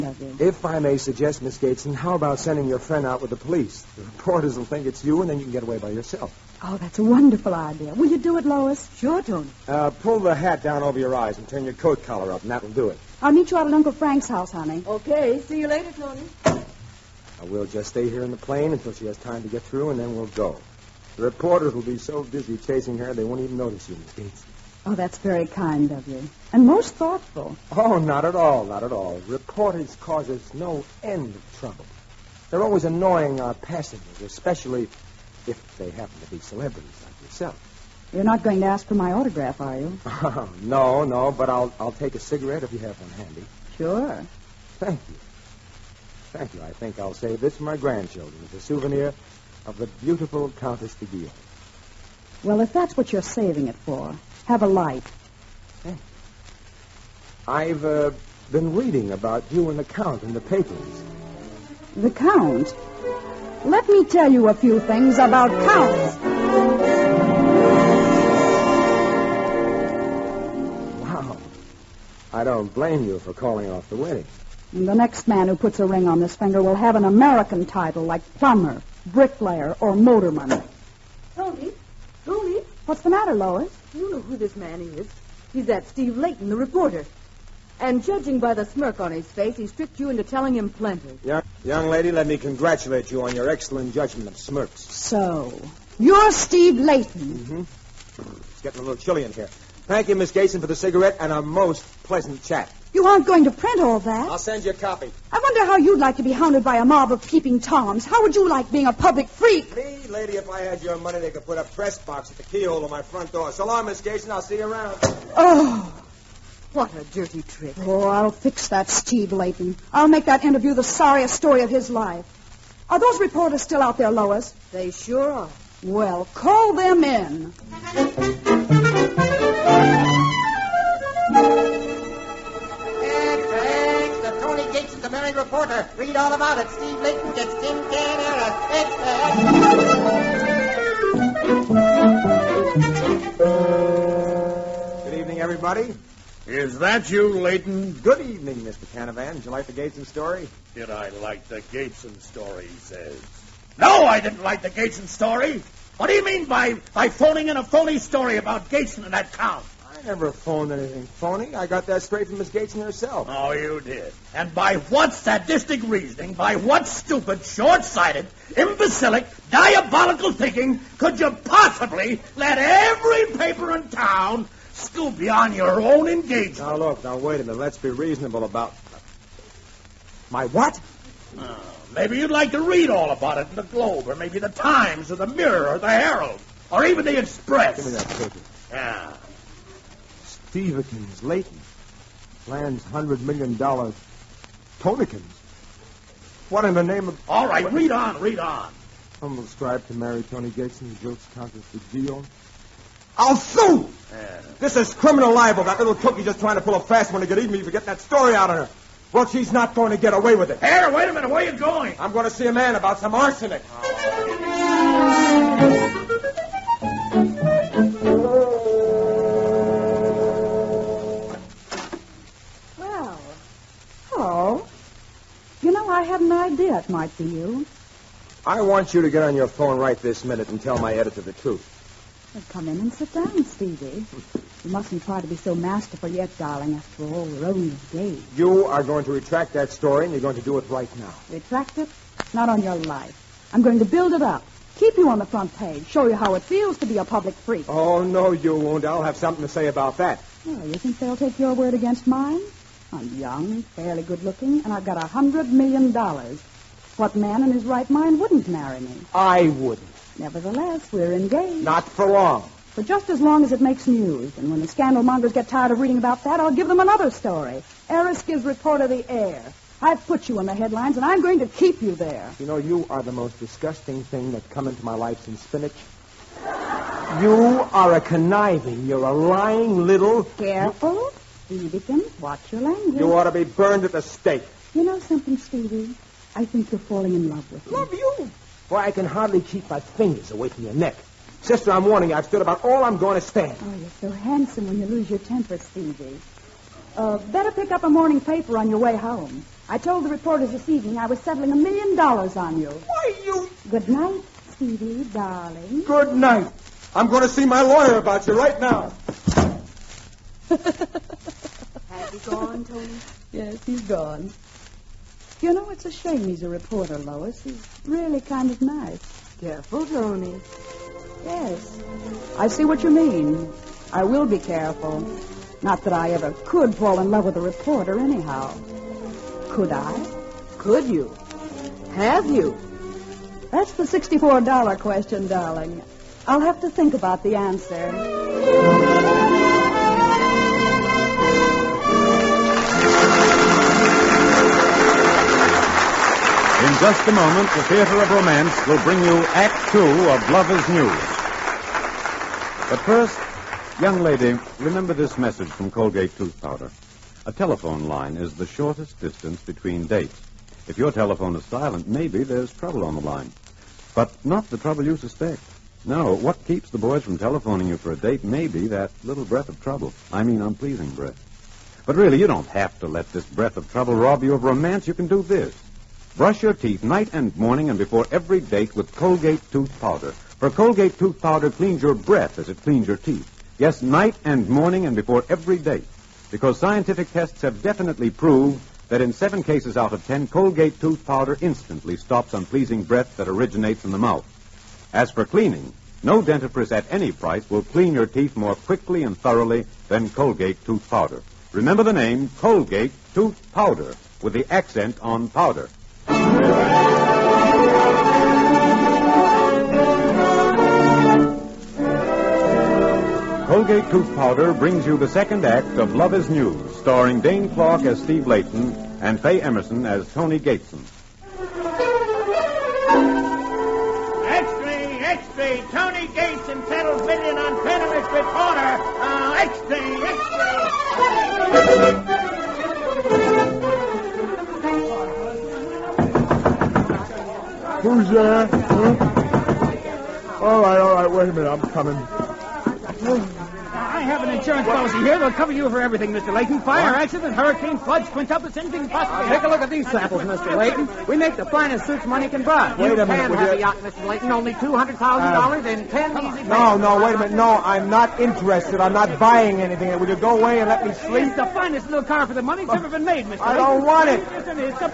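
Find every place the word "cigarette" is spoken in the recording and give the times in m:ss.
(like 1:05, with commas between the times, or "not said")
0:42, 1:40.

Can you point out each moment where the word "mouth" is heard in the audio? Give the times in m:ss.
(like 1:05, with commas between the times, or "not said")
6:33.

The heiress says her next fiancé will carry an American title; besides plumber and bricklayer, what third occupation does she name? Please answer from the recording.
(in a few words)
Motorman.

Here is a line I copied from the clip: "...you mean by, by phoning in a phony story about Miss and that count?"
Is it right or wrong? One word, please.
wrong.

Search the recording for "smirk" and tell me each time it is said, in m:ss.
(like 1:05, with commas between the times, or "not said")
1:28, 1:34.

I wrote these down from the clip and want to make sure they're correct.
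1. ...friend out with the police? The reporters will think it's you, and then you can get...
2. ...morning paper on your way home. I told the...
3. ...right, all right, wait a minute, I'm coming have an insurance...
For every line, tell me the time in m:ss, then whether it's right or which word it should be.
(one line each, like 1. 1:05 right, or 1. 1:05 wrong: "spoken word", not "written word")
1. 0:02 right
2. 4:57 right
3. 7:20 right.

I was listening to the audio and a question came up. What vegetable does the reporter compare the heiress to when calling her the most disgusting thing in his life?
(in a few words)
Spinach.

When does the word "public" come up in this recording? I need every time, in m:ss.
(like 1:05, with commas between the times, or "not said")
1:48, 4:07.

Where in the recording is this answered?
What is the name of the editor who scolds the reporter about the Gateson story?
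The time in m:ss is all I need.
2:28.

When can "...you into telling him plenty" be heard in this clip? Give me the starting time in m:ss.
1:29.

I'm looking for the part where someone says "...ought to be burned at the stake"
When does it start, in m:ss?
4:43.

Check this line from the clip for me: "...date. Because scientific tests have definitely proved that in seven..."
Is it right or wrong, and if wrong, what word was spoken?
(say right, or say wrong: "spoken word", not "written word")
right.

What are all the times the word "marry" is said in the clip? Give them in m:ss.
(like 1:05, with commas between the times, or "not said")
3:19, 4:18.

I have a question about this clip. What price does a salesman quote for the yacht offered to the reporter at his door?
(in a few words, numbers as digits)
$200,000.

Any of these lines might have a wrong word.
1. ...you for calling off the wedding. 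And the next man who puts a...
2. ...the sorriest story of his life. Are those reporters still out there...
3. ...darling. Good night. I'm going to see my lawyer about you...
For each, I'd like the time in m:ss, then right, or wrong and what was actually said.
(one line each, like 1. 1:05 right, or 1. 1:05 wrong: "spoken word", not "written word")
1. 1:13 right
2. 2:00 right
3. 5:05 right.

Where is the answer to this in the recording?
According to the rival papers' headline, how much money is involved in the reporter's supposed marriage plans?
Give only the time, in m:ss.
3:12.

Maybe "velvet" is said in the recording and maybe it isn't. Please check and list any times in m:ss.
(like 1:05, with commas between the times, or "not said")
not said.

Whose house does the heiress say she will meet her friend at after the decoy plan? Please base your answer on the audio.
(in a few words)
Uncle Frank's.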